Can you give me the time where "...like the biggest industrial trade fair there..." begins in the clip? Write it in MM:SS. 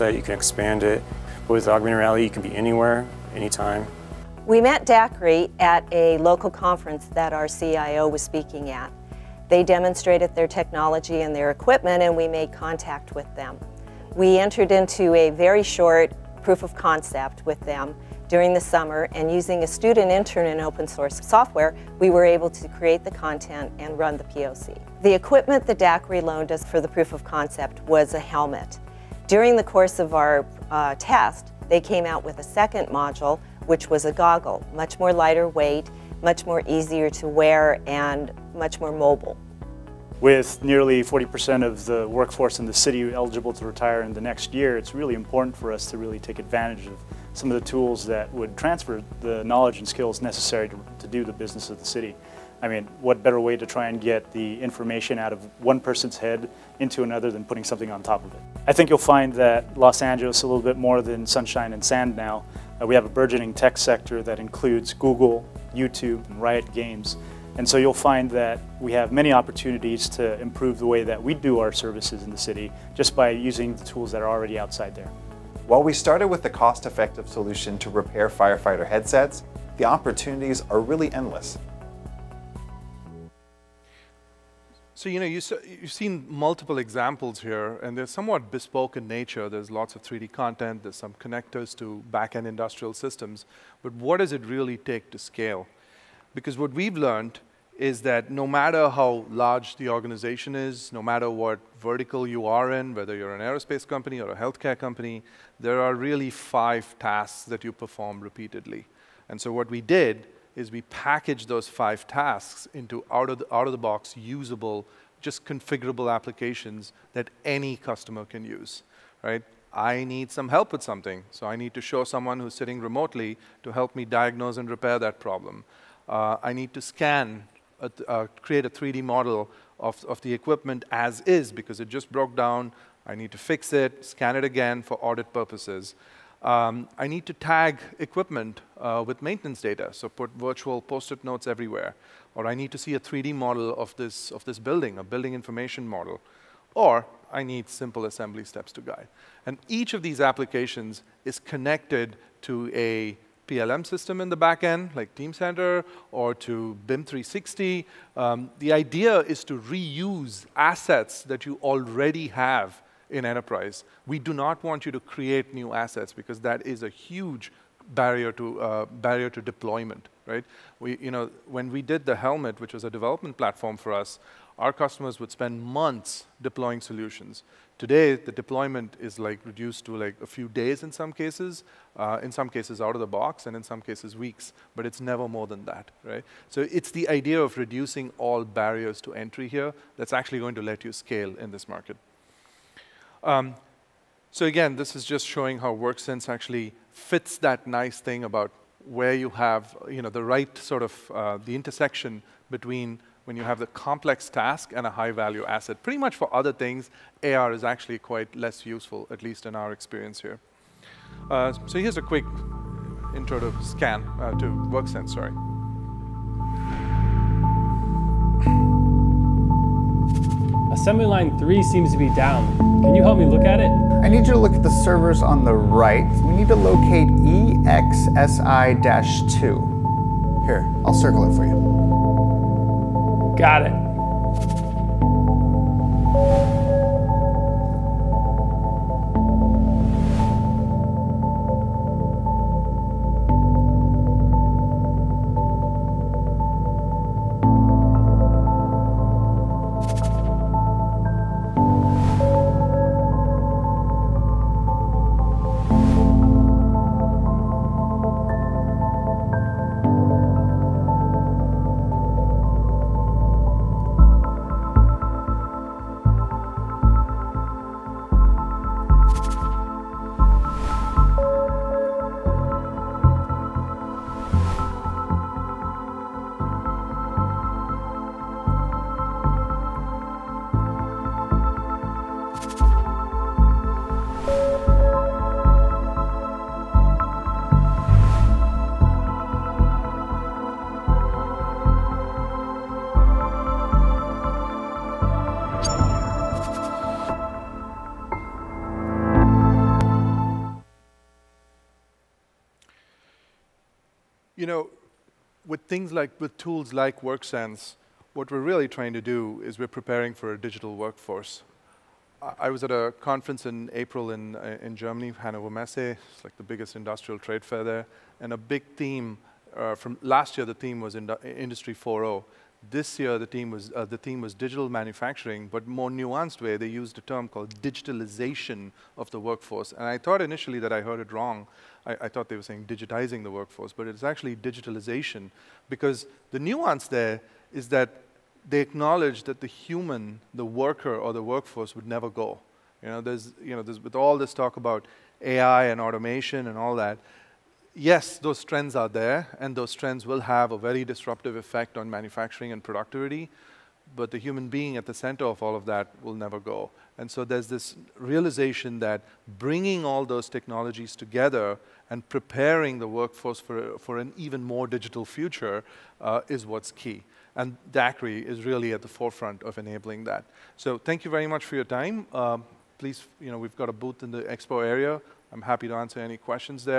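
05:16.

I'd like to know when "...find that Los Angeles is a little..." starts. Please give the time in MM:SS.
00:58.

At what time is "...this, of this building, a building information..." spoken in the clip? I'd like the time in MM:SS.
02:23.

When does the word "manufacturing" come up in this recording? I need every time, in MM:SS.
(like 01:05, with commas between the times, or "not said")
05:24, 05:51.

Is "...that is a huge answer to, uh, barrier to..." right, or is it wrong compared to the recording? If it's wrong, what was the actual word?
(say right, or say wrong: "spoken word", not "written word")
wrong: "barrier", not "answer".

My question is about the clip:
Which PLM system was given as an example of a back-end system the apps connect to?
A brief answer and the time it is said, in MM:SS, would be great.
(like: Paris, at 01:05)
Teamcenter, at 02:35.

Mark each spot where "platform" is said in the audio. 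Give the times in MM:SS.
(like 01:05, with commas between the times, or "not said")
02:53.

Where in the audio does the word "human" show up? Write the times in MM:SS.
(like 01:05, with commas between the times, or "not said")
05:39, 05:54.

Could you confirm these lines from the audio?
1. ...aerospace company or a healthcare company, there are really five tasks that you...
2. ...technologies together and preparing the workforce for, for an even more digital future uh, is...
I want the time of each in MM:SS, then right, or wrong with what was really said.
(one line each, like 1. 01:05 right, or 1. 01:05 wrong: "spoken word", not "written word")
1. 01:43 right
2. 06:00 right.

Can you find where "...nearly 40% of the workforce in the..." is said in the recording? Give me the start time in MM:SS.
00:40.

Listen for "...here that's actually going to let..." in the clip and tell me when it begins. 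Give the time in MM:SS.
03:09.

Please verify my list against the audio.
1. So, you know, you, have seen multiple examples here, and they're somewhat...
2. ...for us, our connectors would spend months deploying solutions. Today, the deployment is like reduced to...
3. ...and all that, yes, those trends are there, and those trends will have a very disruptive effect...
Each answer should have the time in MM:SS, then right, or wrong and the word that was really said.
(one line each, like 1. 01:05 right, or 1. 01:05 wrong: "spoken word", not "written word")
1. 01:25 right
2. 02:53 wrong: "customers", not "connectors"
3. 05:46 right.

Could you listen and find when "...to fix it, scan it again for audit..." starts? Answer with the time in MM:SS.
02:13.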